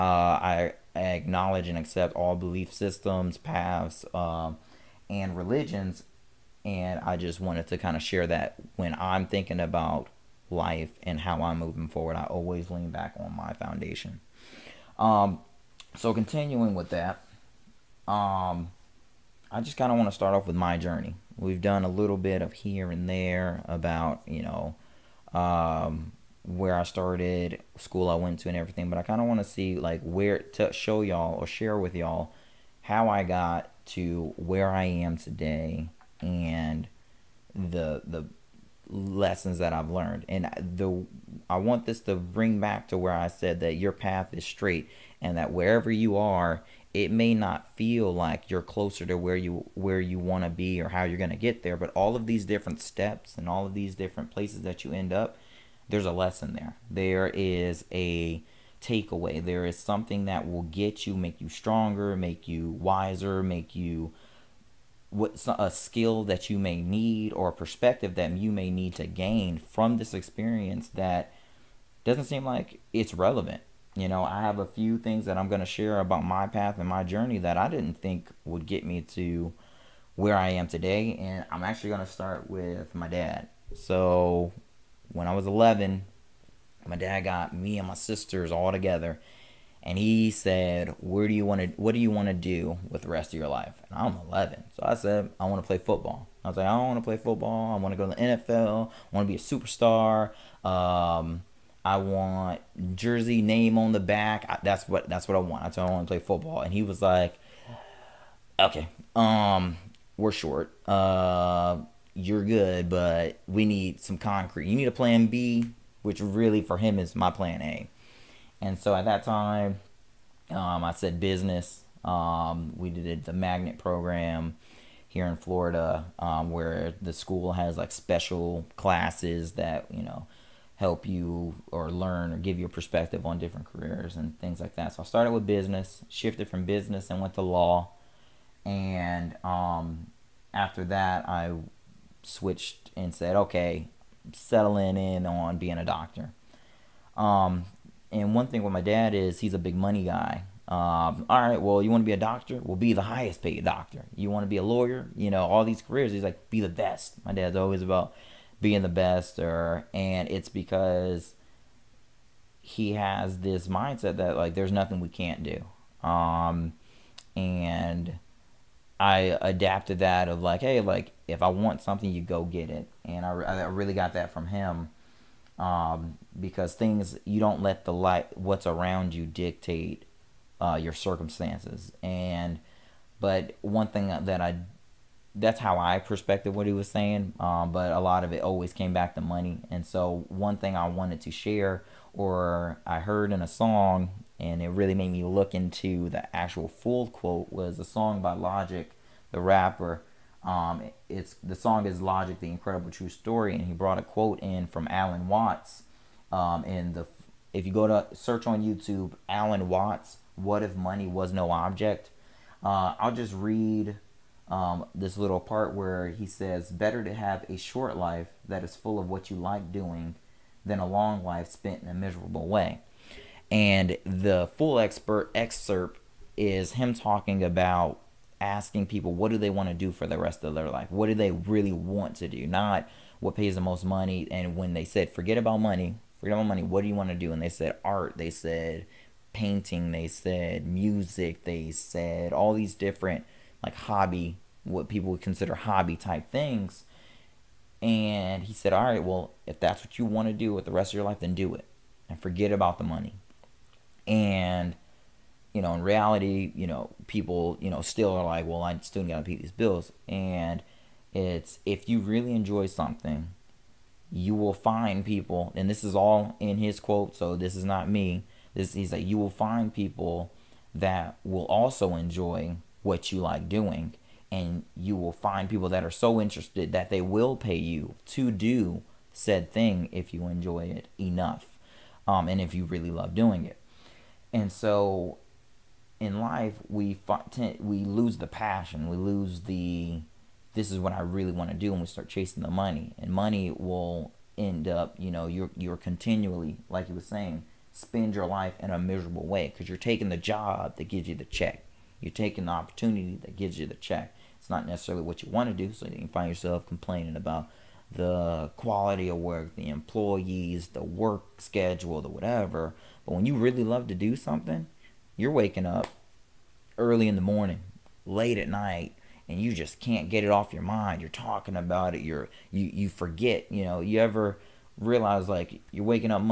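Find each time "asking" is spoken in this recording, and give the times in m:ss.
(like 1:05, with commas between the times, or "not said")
3:48.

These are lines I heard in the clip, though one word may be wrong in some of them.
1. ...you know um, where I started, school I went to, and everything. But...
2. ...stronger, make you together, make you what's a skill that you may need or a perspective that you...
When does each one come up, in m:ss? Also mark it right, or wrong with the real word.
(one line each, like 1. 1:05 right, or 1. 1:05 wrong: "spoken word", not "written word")
1. 0:24 right
2. 1:01 wrong: "wiser", not "together".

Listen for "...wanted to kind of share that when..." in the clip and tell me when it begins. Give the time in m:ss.
0:07.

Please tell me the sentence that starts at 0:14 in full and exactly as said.
Um, so continuing with that, um, I just kind of want to start off with my journey.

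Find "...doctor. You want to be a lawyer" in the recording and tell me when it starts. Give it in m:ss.
2:33.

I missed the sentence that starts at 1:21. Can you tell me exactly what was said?
And I'm actually going to start with my dad.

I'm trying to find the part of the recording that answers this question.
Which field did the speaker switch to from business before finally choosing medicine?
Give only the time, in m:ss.
2:17.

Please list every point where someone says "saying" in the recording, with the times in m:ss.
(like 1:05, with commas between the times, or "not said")
3:06, 4:56.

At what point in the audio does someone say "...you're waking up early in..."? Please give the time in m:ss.
5:15.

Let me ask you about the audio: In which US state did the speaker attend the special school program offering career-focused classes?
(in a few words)
Florida.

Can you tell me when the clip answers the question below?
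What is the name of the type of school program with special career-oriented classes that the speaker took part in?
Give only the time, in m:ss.
2:03.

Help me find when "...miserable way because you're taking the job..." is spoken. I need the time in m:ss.
4:58.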